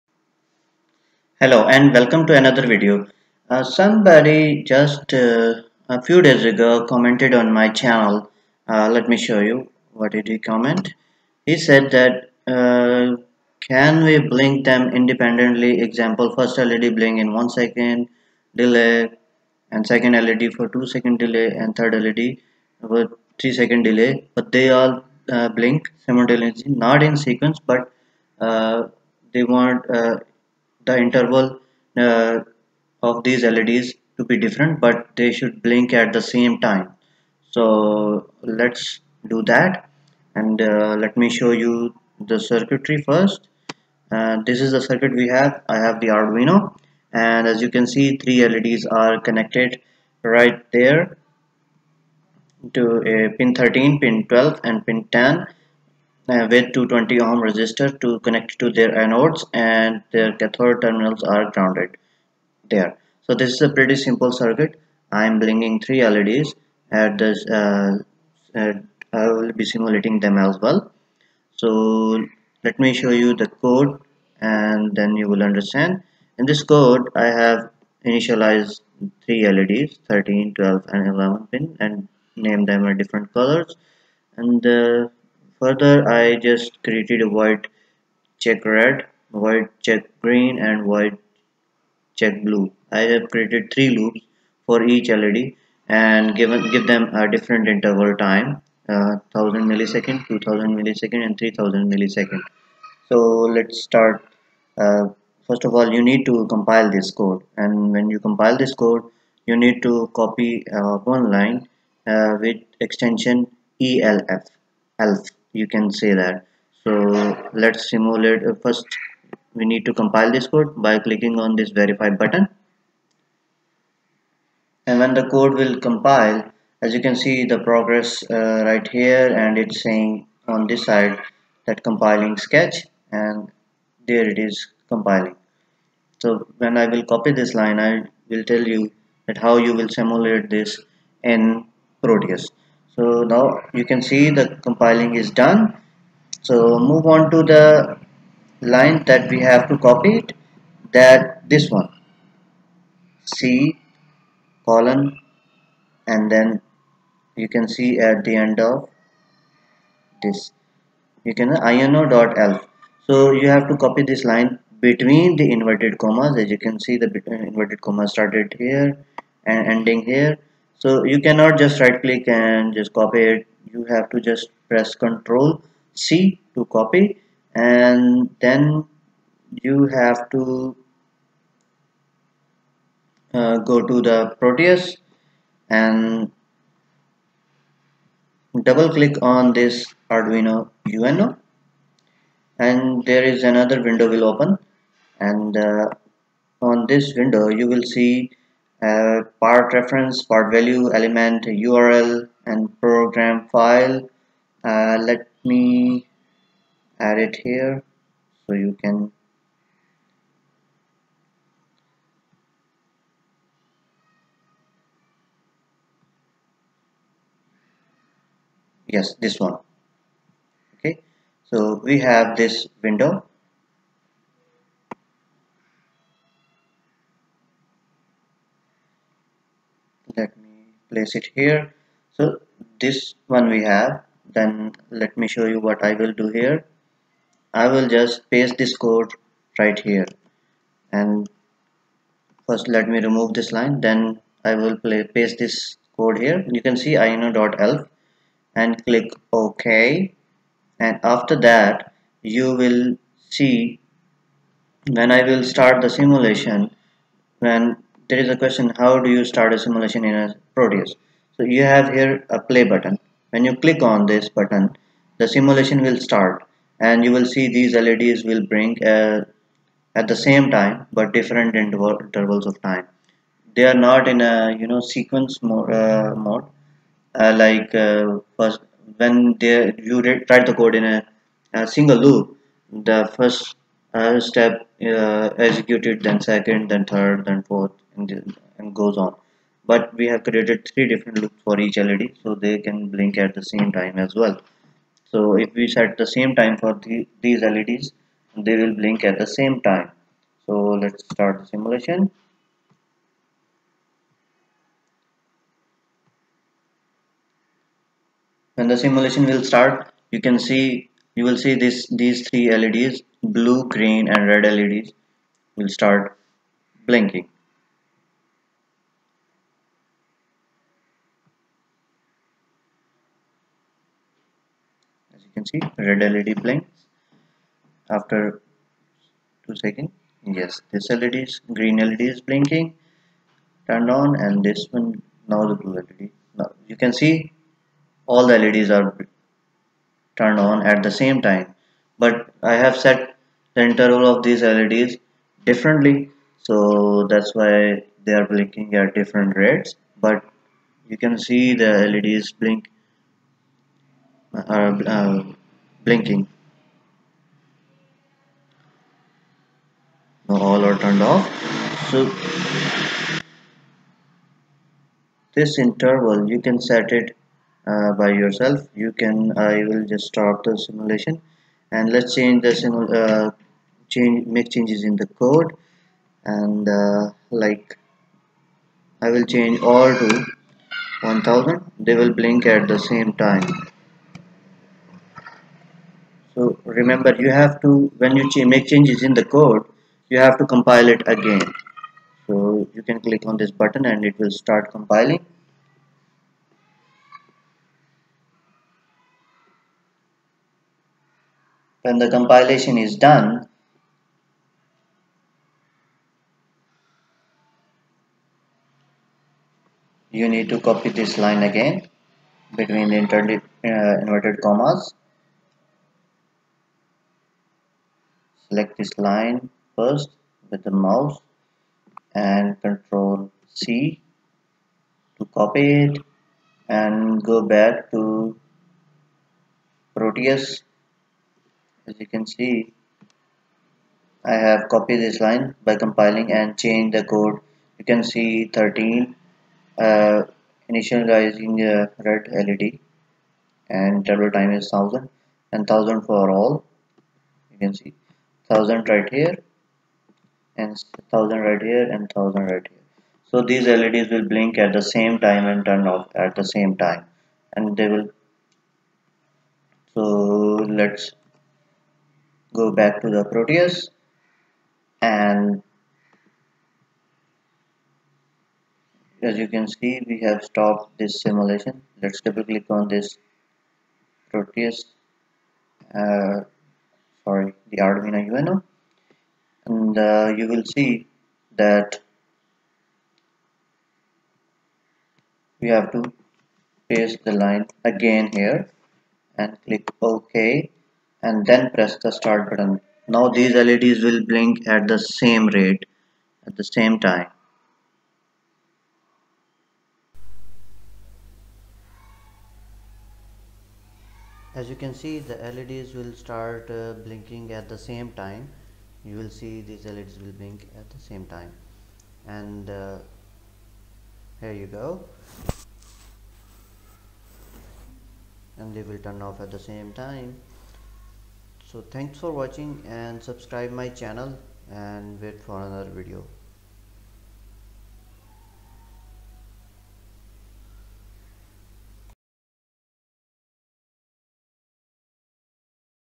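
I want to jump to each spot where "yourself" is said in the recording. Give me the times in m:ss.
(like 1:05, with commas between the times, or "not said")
6:08.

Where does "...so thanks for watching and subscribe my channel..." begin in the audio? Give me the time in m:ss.
8:41.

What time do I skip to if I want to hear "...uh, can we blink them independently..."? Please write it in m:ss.
0:12.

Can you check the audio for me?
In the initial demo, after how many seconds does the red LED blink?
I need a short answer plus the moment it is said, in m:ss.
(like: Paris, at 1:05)
2 seconds, at 5:29.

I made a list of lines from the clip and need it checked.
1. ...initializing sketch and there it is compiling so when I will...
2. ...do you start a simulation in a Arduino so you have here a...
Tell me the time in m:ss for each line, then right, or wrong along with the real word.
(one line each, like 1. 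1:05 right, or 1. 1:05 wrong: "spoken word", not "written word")
1. 2:11 wrong: "compiling", not "initializing"
2. 4:19 wrong: "Proteus", not "Arduino".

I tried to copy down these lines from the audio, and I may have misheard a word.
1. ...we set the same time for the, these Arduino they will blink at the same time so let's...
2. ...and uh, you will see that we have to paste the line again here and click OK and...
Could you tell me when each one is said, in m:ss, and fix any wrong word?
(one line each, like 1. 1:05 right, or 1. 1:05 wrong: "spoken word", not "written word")
1. 4:55 wrong: "LEDs", not "Arduino"
2. 7:59 right.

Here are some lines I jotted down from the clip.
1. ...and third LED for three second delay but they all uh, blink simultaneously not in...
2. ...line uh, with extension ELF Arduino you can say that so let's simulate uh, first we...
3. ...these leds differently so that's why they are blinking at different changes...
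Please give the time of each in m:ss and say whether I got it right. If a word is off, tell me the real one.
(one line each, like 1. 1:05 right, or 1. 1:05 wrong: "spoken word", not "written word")
1. 0:21 right
2. 1:51 wrong: "ELF", not "Arduino"
3. 5:44 wrong: "rates", not "changes".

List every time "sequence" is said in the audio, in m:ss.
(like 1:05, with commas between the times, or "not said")
0:27, 4:34.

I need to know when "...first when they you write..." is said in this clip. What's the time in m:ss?
4:38.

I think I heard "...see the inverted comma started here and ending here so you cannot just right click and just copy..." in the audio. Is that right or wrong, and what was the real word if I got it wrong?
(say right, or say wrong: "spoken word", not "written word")
right.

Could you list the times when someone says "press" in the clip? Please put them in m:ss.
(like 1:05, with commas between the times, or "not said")
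2:54, 8:11.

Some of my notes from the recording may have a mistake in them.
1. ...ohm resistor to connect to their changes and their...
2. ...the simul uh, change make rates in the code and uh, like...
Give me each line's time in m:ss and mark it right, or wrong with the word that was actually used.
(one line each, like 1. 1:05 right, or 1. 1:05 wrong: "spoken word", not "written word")
1. 0:57 wrong: "anodes", not "changes"
2. 6:12 wrong: "changes", not "rates".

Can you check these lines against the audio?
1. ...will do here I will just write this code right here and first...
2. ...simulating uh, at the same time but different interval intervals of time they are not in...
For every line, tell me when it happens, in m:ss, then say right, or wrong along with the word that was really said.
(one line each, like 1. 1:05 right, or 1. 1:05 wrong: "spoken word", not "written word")
1. 3:56 wrong: "paste", not "write"
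2. 4:28 wrong: "bring", not "simulating".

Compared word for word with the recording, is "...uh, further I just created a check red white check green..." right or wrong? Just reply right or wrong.
right.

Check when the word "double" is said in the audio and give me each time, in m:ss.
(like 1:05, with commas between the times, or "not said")
3:08, 7:24, 7:52.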